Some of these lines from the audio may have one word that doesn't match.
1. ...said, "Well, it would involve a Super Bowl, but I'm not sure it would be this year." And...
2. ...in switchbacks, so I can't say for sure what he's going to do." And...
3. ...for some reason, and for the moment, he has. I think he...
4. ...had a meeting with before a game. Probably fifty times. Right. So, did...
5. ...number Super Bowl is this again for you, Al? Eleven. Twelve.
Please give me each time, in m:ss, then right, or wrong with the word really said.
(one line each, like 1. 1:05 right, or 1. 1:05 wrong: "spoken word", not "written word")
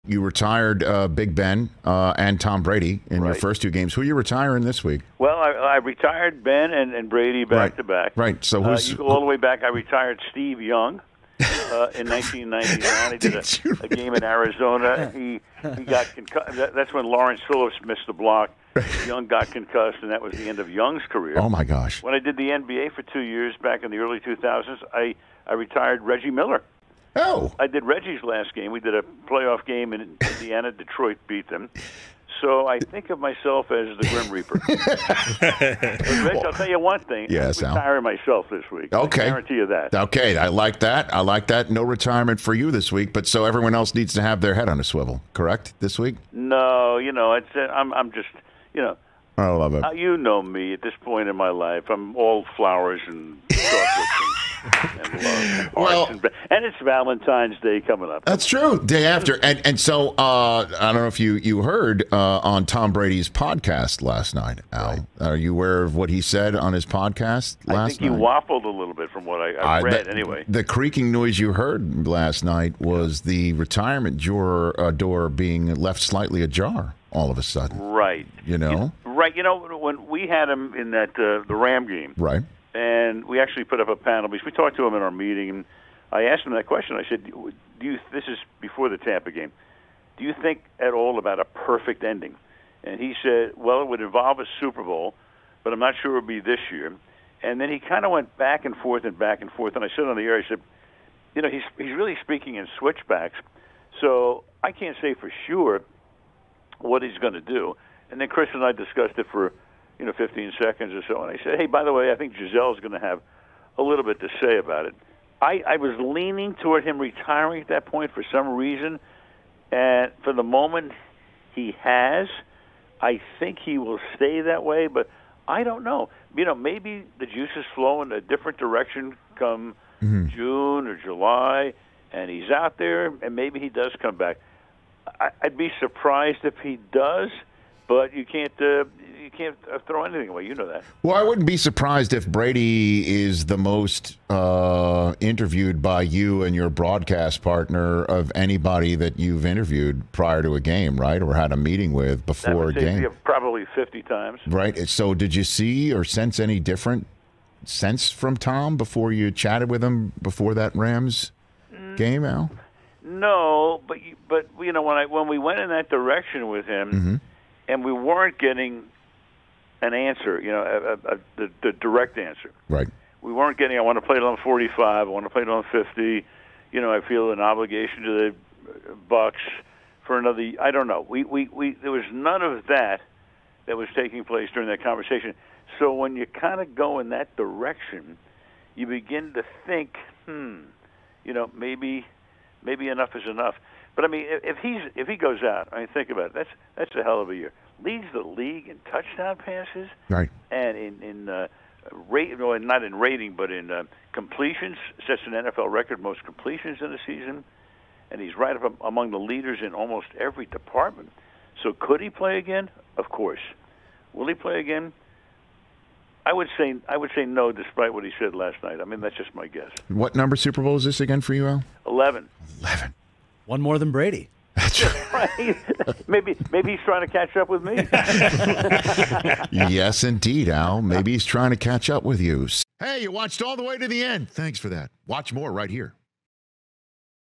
1. 1:33 right
2. 1:42 right
3. 1:58 right
4. 2:31 right
5. 3:40 wrong: "Eleven", not "Twelve".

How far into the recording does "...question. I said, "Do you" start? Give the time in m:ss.
1:26.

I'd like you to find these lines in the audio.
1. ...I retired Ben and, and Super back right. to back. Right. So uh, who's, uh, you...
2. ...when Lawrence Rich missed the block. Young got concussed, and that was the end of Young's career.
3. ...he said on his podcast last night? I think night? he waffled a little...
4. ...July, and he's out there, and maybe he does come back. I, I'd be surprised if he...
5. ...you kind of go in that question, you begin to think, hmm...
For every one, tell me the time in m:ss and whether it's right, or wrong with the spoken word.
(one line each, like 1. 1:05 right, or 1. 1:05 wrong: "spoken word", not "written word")
1. 0:05 wrong: "Brady", not "Super"
2. 0:16 wrong: "Phillips", not "Rich"
3. 1:06 right
4. 2:10 right
5. 3:06 wrong: "direction", not "question".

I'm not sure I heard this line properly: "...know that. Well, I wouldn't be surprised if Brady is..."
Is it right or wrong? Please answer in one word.
right.